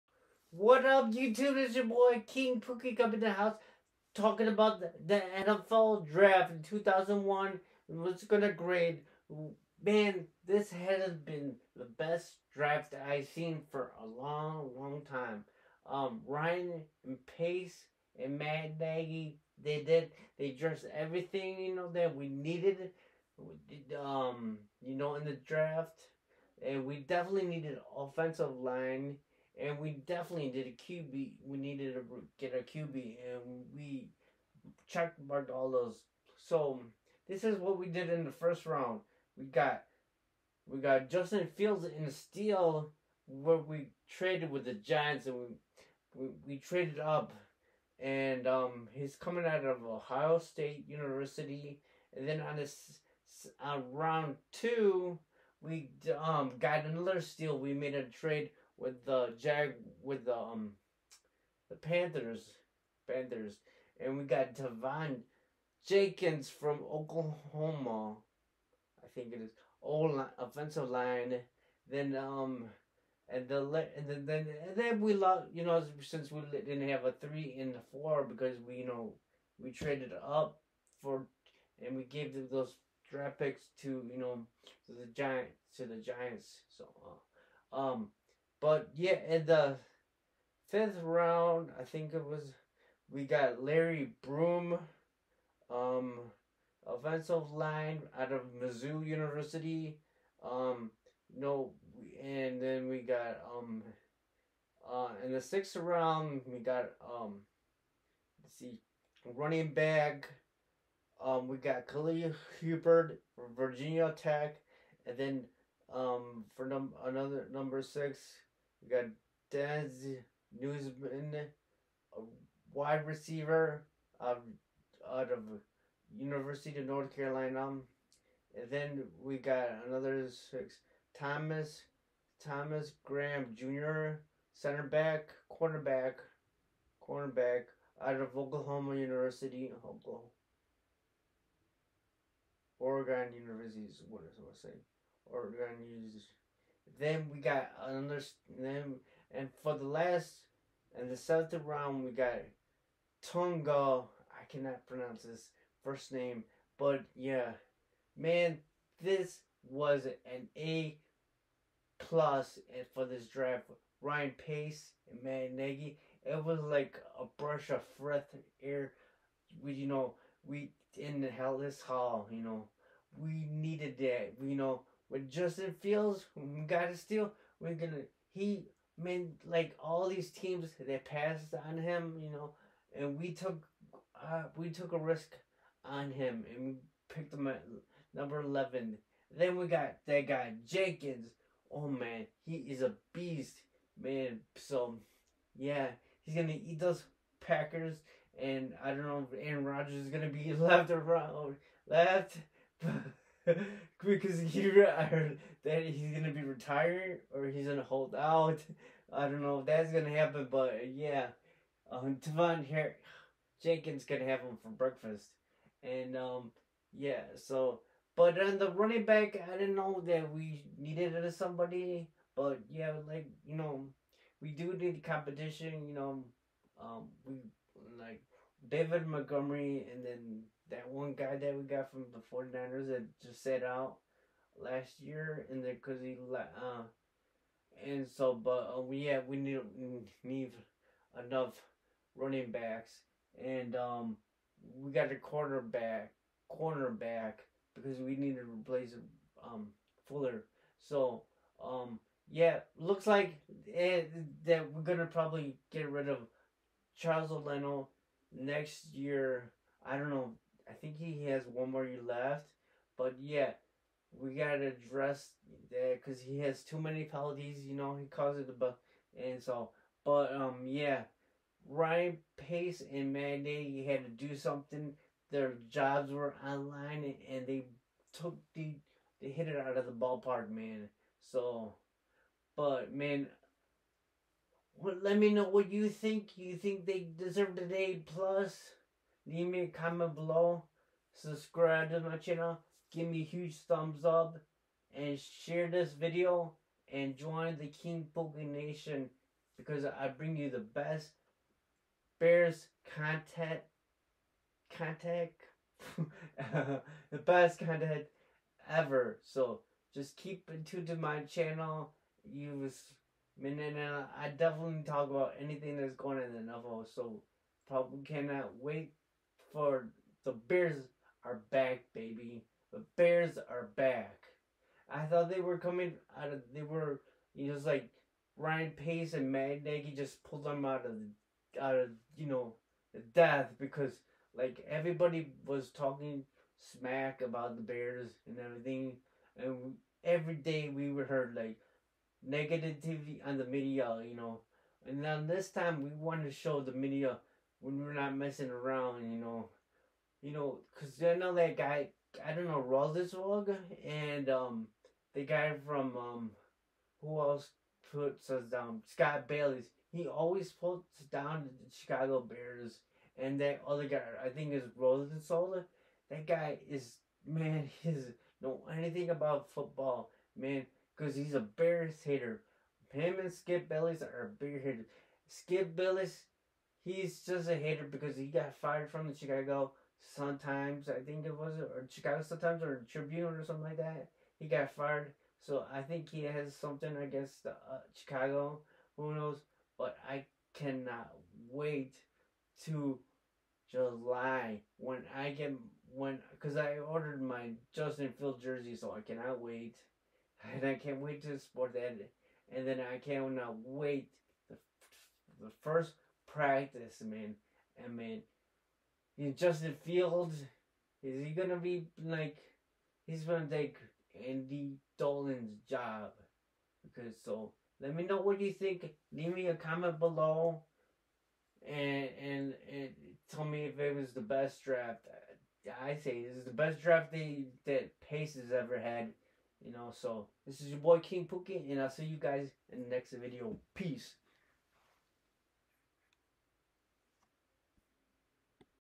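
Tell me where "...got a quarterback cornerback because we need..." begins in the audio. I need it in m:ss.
4:04.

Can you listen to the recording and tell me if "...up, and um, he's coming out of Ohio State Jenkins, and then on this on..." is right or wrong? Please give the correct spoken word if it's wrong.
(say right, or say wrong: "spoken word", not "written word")
wrong: "University", not "Jenkins".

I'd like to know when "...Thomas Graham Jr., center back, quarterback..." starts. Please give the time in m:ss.
2:12.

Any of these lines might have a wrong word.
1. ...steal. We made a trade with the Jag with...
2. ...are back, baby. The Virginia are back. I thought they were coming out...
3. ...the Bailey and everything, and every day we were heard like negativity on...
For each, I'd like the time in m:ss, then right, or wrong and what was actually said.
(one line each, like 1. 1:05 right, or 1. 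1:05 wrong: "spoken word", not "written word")
1. 0:57 right
2. 5:21 wrong: "Bears", not "Virginia"
3. 5:37 wrong: "Bears", not "Bailey".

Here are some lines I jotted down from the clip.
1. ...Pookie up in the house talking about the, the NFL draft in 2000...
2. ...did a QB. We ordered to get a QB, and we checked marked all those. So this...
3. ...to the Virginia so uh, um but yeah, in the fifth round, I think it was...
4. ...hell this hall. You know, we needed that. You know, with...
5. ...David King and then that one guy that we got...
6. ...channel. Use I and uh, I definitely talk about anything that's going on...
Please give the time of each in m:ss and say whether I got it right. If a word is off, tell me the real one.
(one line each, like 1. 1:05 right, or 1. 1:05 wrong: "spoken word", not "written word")
1. 0:02 wrong: "2001", not "2000"
2. 0:30 wrong: "needed", not "ordered"
3. 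1:25 wrong: "Giants", not "Virginia"
4. 2:51 right
5. 3:48 wrong: "Montgomery", not "King"
6. 5:11 right.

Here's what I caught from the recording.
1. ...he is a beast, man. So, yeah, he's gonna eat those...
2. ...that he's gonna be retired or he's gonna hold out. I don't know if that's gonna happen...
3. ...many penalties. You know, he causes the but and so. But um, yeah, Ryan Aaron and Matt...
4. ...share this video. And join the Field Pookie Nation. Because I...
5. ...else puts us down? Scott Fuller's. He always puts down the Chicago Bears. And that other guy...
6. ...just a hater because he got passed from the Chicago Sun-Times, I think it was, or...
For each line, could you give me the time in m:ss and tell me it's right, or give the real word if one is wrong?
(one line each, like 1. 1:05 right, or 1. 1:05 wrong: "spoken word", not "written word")
1. 3:12 right
2. 3:25 right
3. 4:26 wrong: "Pace", not "Aaron"
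4. 4:55 wrong: "King", not "Field"
5. 5:57 wrong: "Bailey", not "Fuller"
6. 6:17 wrong: "fired", not "passed".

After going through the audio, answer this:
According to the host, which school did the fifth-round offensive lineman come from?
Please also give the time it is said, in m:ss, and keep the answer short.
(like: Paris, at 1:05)
Mizzou, at 1:38.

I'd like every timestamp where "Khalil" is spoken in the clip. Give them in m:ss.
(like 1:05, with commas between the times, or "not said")
1:51.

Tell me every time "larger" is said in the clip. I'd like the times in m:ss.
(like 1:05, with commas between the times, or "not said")
not said.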